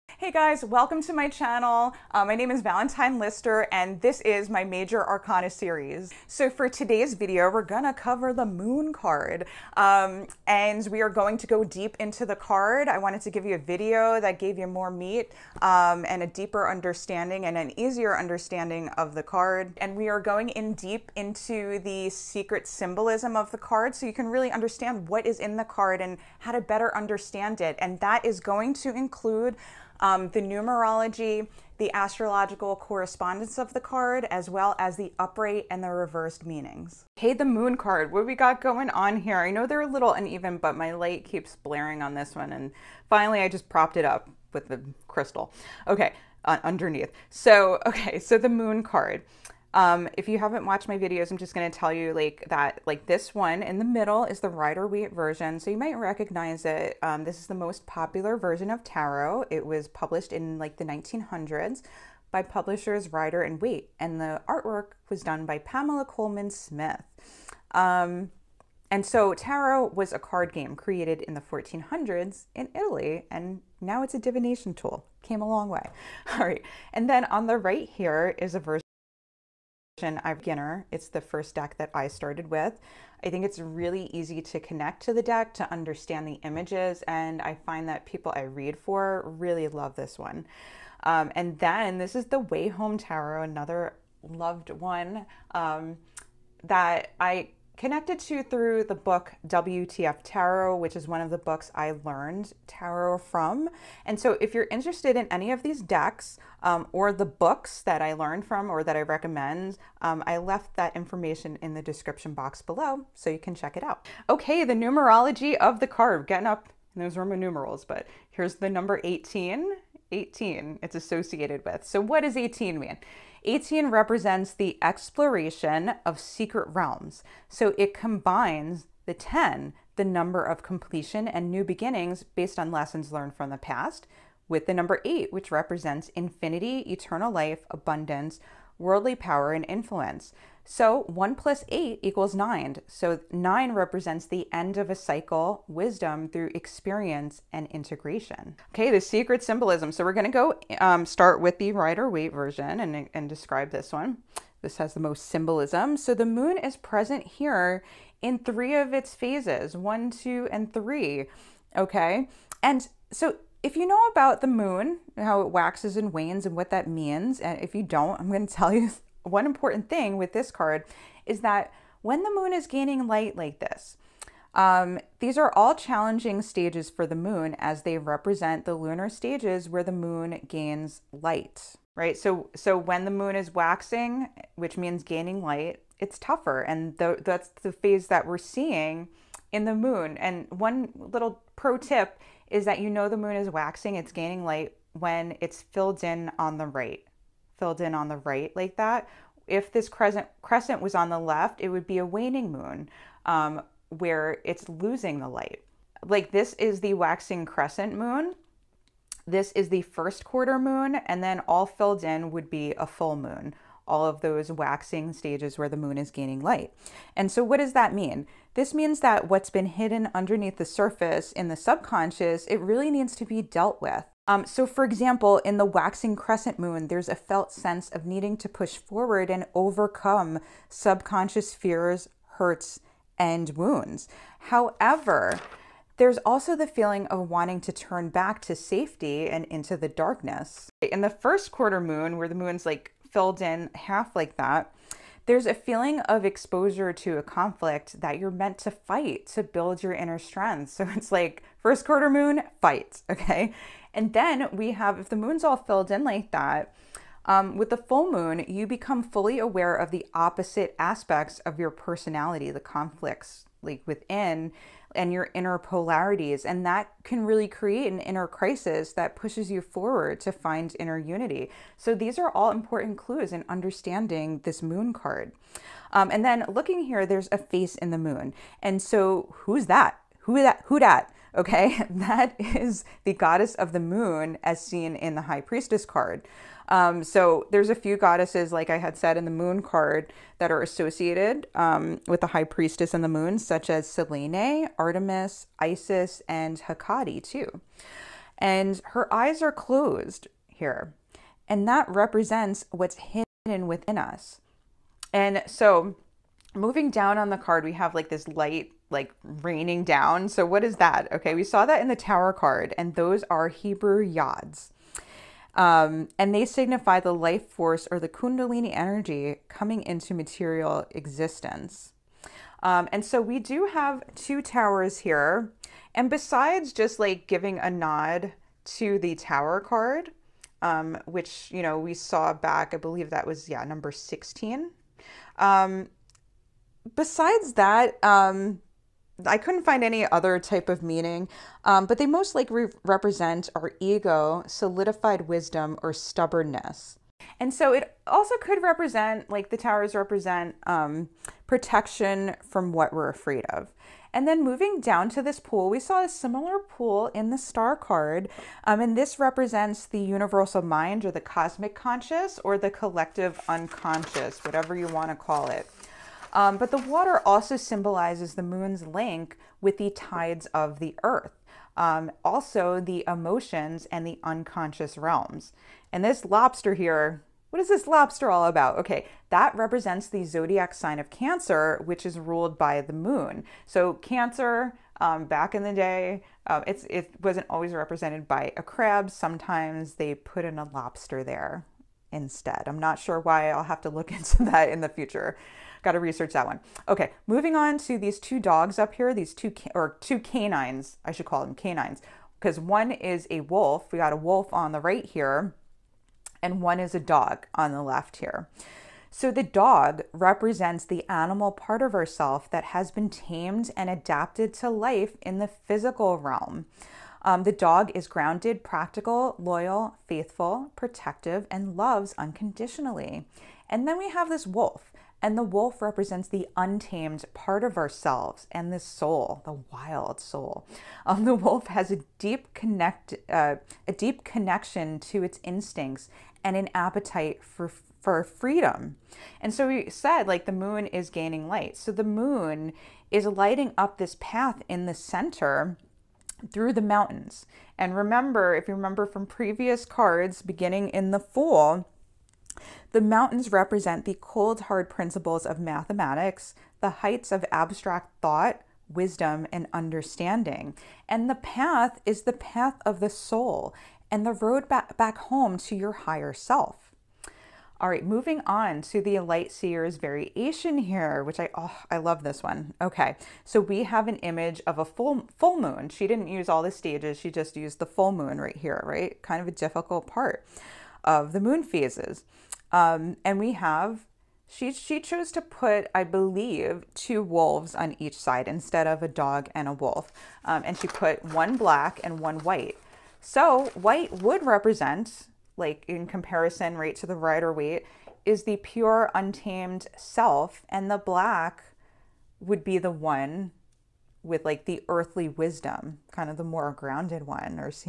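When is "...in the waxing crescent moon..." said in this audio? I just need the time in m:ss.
3:45.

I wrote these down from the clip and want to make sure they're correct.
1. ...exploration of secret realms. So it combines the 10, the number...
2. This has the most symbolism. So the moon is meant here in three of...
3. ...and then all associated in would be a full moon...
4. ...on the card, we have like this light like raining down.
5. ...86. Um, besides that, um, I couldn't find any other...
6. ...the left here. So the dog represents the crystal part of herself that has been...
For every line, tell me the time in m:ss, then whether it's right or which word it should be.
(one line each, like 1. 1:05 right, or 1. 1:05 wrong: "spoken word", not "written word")
1. 2:04 right
2. 2:34 wrong: "present", not "meant"
3. 3:31 wrong: "filled", not "associated"
4. 5:07 right
5. 5:33 wrong: "16", not "86"
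6. 6:47 wrong: "animal", not "crystal".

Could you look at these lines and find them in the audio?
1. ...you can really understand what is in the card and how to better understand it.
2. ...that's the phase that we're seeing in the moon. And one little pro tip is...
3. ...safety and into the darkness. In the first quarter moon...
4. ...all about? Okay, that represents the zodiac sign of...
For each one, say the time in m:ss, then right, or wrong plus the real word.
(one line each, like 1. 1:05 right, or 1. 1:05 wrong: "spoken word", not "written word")
1. 0:24 right
2. 3:07 right
3. 3:58 right
4. 6:18 right.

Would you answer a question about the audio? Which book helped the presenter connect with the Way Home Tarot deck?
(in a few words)
WTF Tarot.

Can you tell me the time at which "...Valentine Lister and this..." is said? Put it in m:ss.
0:02.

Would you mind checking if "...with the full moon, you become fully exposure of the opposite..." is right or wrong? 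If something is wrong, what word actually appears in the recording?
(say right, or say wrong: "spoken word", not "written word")
wrong: "aware", not "exposure".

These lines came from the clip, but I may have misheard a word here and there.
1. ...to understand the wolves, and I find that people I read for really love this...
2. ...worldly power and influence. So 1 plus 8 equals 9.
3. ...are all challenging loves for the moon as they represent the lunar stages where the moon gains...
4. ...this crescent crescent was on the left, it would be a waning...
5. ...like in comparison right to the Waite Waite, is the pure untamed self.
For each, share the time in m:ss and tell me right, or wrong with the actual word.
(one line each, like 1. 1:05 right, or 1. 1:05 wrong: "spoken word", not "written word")
1. 1:25 wrong: "images", not "wolves"
2. 2:18 right
3. 2:55 wrong: "stages", not "loves"
4. 3:19 right
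5. 8:15 wrong: "Rider", not "Waite".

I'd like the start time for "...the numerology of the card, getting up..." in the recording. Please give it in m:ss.
1:54.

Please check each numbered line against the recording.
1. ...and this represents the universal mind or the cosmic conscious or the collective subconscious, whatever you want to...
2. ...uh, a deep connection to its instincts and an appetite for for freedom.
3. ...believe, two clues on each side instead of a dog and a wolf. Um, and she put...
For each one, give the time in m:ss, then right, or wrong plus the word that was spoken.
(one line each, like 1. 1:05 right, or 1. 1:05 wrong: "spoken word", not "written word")
1. 5:58 wrong: "unconscious", not "subconscious"
2. 7:13 right
3. 8:06 wrong: "wolves", not "clues".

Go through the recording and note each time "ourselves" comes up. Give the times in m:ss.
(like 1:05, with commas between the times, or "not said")
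7:07.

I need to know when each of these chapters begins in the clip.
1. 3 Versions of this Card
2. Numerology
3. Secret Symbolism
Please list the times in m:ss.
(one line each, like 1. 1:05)
1. 0:36
2. 1:53
3. 2:28.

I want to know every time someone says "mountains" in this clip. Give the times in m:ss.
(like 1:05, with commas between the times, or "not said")
7:26, 7:33.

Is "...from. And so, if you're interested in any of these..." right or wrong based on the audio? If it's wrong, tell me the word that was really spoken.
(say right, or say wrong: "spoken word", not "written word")
right.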